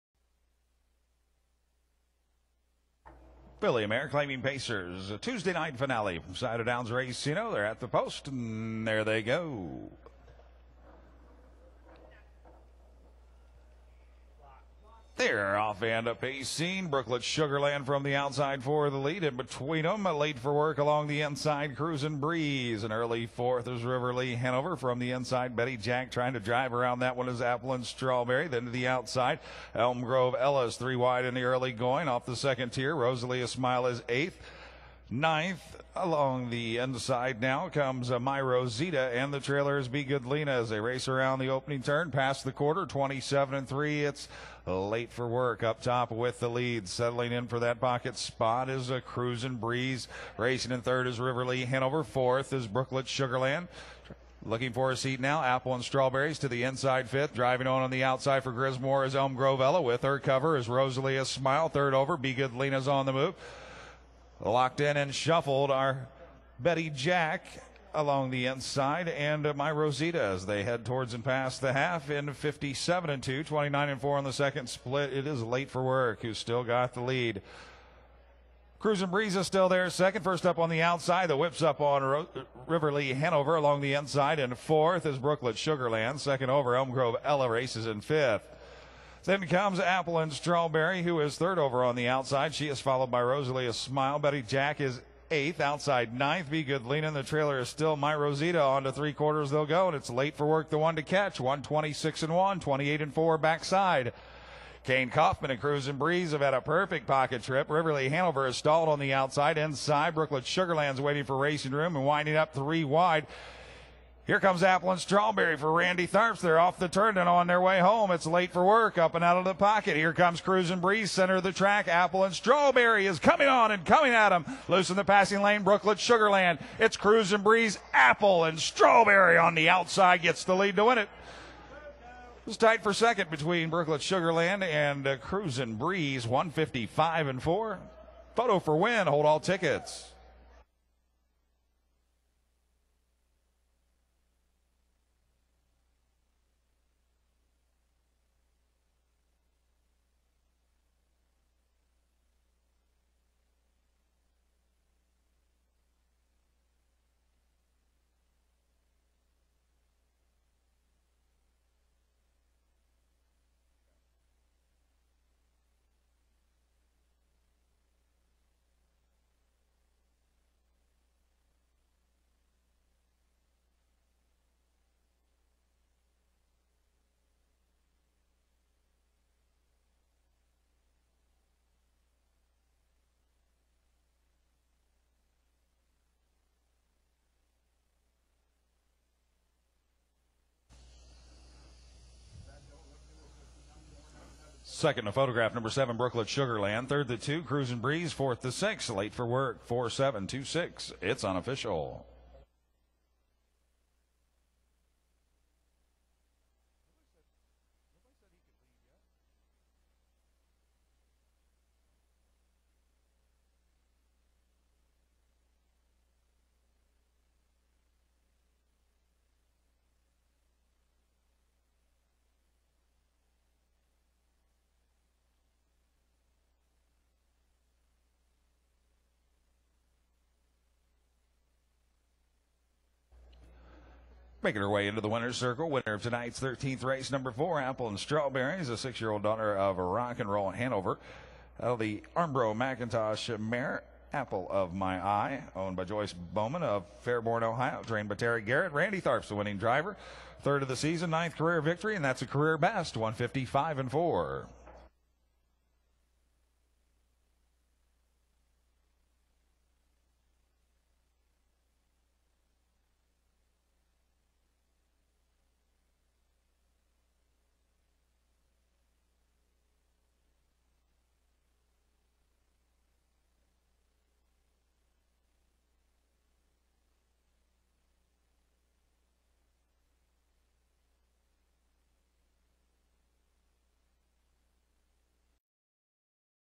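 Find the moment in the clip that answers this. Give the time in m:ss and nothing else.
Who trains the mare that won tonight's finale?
4:08.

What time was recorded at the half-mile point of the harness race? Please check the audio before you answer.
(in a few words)
57.2.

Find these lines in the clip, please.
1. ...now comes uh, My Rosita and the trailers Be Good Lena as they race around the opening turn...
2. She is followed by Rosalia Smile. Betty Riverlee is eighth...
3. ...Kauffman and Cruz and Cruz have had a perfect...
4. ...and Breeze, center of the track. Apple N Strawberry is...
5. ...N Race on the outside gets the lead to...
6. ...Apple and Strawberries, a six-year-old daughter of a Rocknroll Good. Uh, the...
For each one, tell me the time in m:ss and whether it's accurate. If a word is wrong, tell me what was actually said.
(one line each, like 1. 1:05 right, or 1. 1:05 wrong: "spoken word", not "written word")
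1. 0:37 right
2. 1:32 wrong: "Jack", not "Riverlee"
3. 1:45 wrong: "Breeze", not "Cruz"
4. 2:00 right
5. 2:08 wrong: "Strawberry", not "Race"
6. 3:57 wrong: "Hanover", not "Good".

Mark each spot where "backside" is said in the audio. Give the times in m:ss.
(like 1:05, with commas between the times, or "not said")
1:43.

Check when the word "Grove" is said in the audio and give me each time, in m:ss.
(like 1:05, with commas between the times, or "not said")
0:30, 0:59, 1:26.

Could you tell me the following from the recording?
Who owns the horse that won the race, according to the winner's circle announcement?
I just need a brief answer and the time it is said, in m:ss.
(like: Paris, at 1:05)
Joyce Bowman, at 4:05.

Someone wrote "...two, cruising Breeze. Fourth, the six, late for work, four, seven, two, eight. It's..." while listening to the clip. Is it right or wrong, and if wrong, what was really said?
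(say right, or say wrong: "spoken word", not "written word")
wrong: "six", not "eight".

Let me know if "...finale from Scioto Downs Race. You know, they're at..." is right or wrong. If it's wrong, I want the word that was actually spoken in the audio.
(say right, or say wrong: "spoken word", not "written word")
right.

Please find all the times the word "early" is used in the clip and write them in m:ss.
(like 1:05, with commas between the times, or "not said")
0:22, 0:31.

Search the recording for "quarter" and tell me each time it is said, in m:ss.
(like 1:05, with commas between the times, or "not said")
0:42, 1:39.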